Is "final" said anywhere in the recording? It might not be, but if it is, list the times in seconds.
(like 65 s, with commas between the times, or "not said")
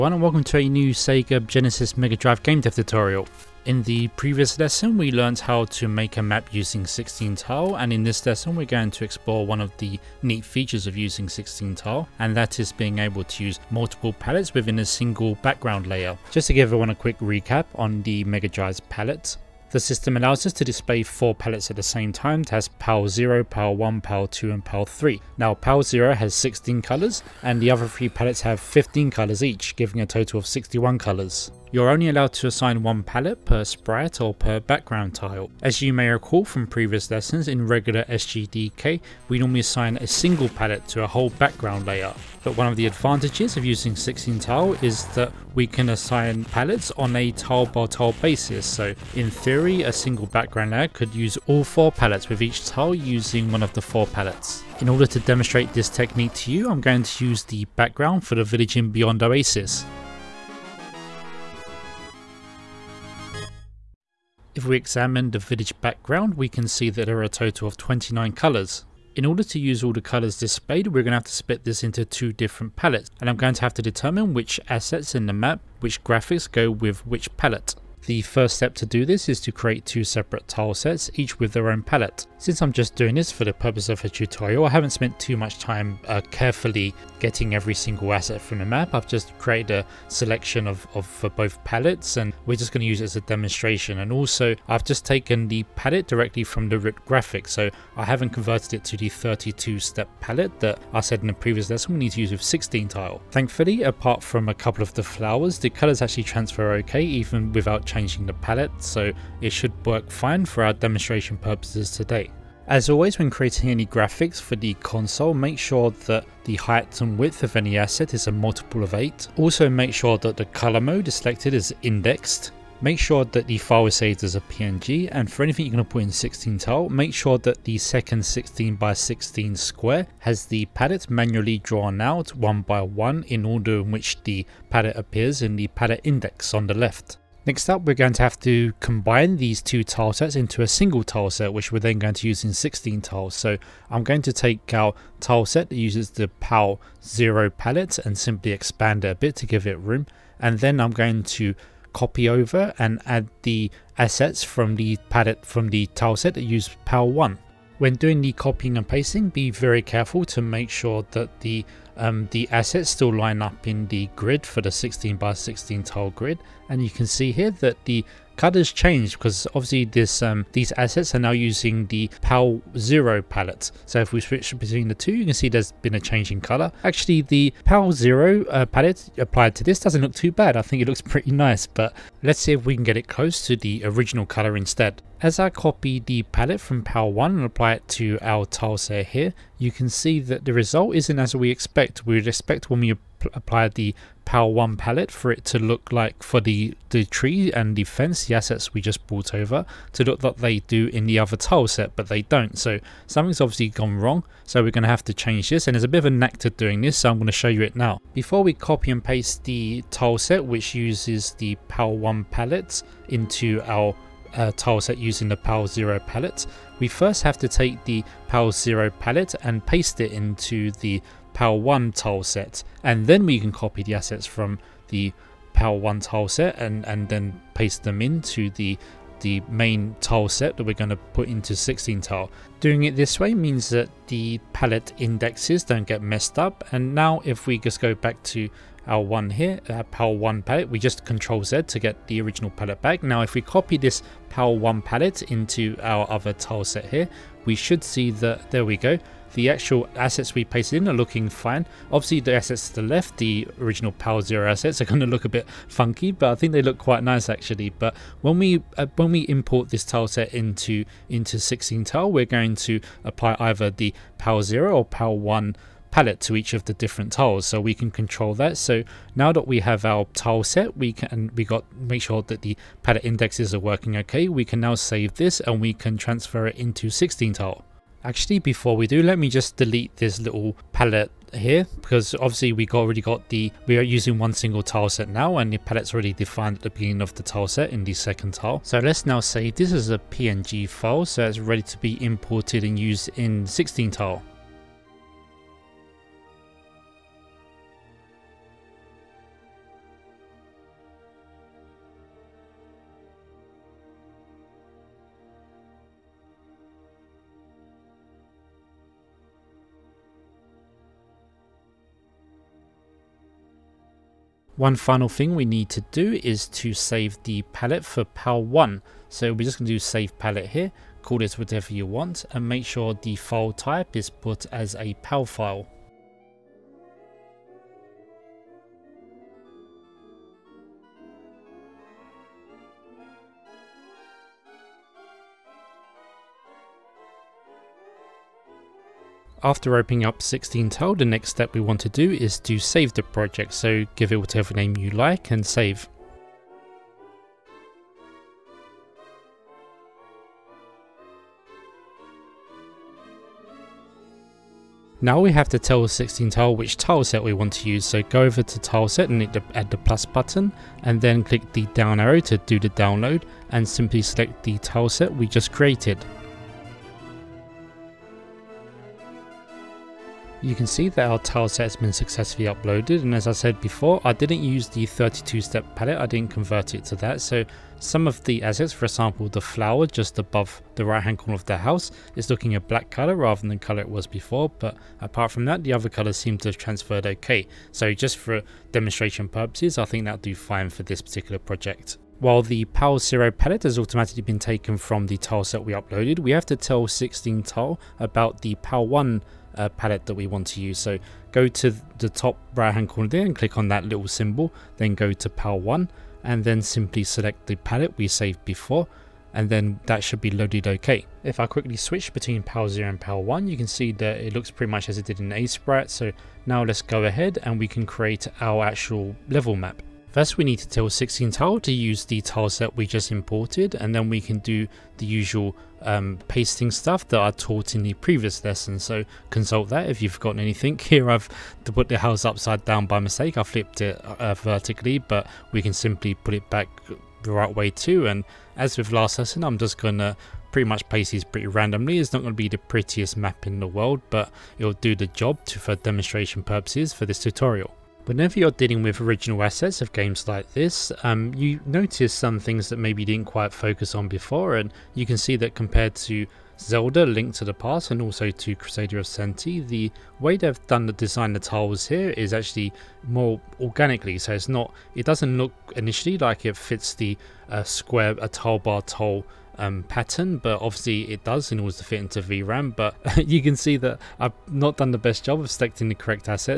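314 s.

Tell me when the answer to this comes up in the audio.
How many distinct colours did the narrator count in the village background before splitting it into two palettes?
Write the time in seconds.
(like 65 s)
67 s.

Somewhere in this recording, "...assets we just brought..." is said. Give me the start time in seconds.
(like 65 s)
198 s.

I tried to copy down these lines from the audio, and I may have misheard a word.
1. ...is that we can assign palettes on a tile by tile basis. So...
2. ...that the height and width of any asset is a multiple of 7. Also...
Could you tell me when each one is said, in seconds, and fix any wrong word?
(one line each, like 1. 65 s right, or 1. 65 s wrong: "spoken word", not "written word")
1. 44 s right
2. 116 s wrong: "8", not "7".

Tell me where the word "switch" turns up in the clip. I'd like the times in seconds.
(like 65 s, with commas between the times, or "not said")
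174 s, 411 s.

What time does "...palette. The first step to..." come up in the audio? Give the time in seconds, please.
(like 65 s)
77 s.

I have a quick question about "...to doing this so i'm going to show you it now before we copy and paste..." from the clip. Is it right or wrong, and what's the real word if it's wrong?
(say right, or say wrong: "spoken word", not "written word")
right.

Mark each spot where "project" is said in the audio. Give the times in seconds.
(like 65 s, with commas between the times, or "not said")
343 s, 391 s.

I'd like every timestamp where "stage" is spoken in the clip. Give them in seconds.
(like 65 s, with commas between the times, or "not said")
not said.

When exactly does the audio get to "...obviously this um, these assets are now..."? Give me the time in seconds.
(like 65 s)
169 s.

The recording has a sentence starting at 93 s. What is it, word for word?
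And also I've just taken the palette directly from the root graphic.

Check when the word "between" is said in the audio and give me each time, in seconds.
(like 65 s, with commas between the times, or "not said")
174 s, 412 s.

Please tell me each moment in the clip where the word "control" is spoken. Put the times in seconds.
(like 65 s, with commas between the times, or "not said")
241 s, 267 s.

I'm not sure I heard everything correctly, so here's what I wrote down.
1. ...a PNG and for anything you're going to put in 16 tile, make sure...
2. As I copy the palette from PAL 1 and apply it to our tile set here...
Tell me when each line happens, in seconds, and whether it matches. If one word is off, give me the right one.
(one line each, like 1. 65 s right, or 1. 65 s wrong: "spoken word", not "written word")
1. 124 s right
2. 185 s right.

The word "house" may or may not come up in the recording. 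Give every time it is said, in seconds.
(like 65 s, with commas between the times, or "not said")
381 s, 431 s.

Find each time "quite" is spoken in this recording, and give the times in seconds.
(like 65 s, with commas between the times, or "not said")
256 s, 453 s.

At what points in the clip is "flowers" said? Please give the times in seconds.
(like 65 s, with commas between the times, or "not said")
105 s, 379 s.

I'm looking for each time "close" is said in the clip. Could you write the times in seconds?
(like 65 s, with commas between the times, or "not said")
183 s.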